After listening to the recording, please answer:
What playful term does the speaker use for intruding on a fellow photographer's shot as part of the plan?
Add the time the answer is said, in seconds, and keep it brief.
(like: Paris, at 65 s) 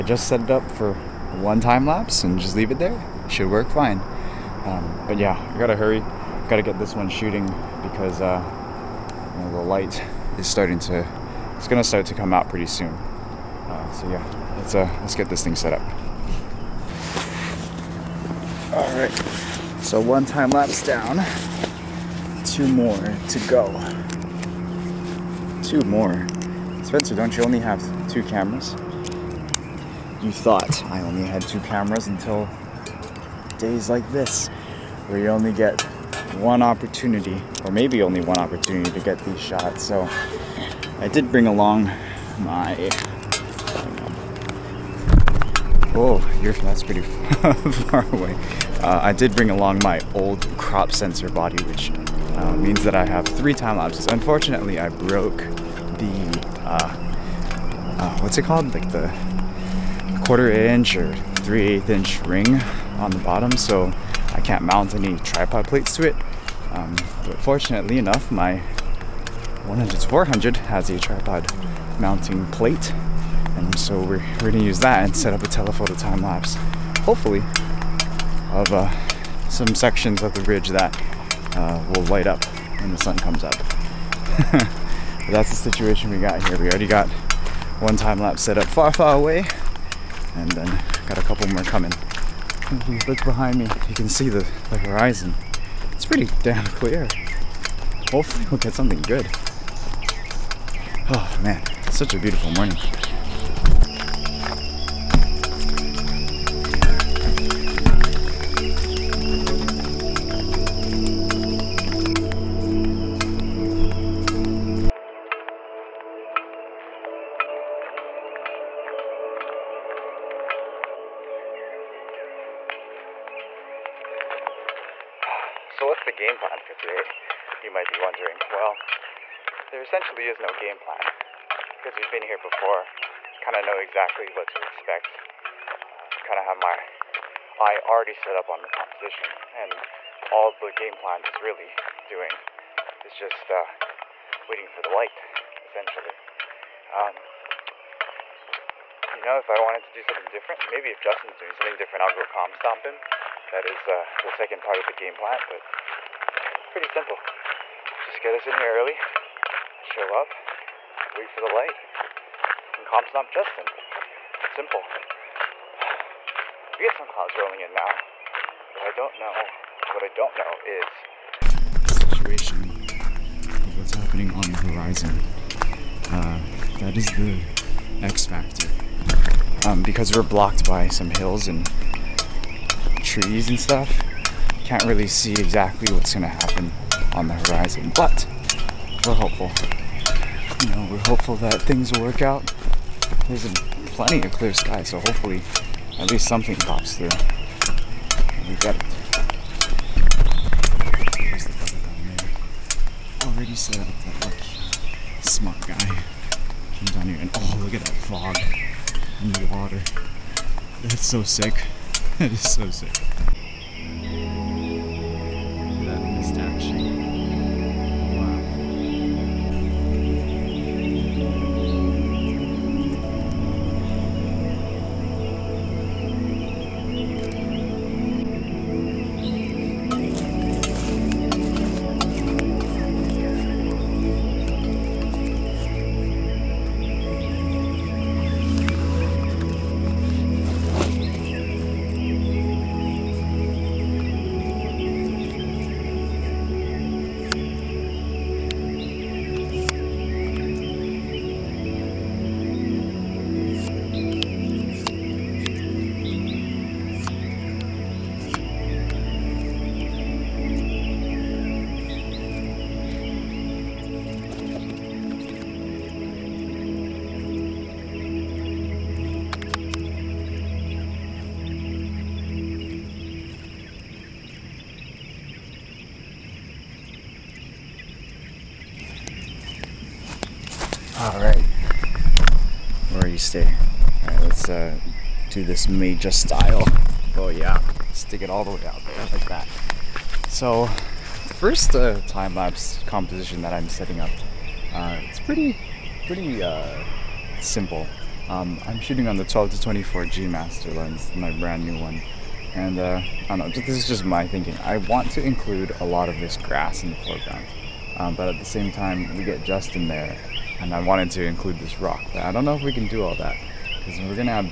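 comp stomping, at 152 s.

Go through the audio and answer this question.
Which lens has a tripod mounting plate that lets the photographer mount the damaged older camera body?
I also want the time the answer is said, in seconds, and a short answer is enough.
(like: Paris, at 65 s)
100 to 400, at 69 s.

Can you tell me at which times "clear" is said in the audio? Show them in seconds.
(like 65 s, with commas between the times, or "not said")
96 s, 194 s.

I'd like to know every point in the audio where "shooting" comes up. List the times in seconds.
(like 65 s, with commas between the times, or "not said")
7 s, 298 s.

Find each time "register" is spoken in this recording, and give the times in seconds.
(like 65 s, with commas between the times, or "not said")
not said.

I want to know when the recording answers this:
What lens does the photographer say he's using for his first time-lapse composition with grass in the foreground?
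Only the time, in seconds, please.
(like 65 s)
299 s.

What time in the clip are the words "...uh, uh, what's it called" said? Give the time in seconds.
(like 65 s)
56 s.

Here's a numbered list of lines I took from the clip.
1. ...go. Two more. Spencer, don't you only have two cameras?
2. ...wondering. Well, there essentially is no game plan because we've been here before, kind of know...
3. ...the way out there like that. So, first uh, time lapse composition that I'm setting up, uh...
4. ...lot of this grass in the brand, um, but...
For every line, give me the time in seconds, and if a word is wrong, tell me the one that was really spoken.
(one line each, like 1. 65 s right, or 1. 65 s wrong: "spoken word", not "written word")
1. 23 s right
2. 128 s right
3. 288 s right
4. 305 s wrong: "foreground", not "brand".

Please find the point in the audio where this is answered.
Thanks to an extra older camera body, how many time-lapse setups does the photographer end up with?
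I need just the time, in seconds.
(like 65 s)
53 s.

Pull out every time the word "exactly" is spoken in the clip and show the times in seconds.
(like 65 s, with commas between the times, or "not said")
133 s, 185 s.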